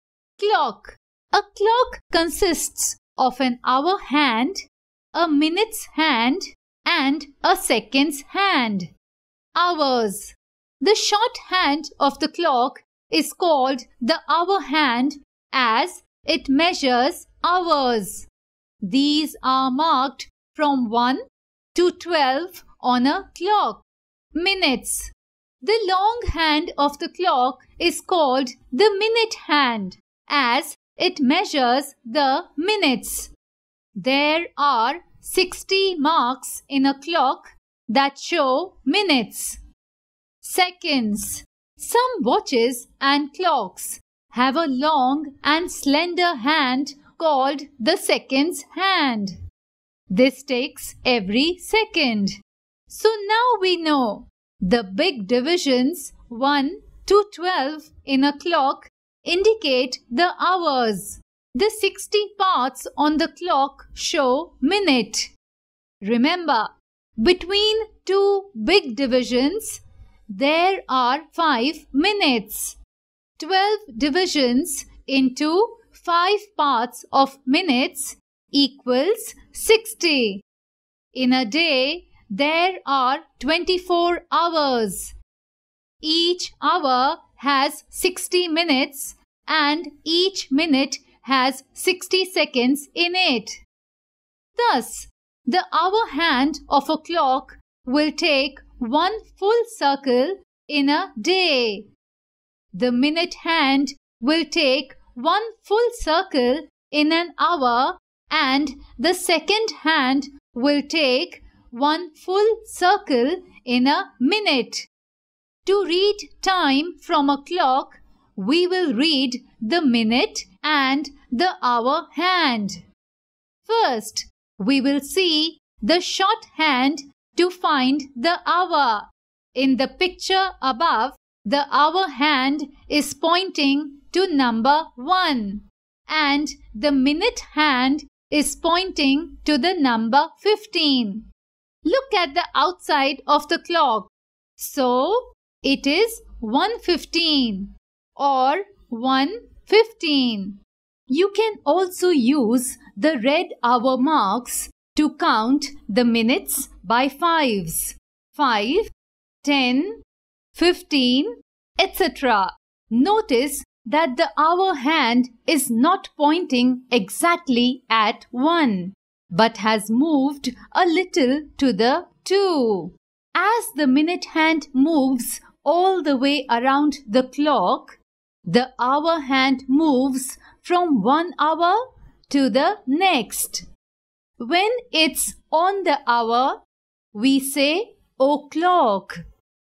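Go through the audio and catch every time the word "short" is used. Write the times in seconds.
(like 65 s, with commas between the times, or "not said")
10 s, 126 s.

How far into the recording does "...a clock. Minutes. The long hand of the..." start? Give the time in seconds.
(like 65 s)
23 s.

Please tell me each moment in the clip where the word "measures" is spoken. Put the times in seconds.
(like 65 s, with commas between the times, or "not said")
16 s, 31 s.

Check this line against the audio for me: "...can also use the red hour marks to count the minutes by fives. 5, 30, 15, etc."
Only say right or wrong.
wrong.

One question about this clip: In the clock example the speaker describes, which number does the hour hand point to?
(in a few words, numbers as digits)
1.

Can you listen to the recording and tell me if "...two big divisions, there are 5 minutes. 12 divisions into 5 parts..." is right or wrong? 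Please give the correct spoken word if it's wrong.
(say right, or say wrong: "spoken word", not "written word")
right.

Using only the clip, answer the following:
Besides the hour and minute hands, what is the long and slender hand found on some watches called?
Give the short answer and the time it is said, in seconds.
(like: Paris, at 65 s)
seconds hand, at 47 s.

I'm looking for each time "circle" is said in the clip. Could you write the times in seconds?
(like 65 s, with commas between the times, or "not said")
99 s, 105 s, 112 s.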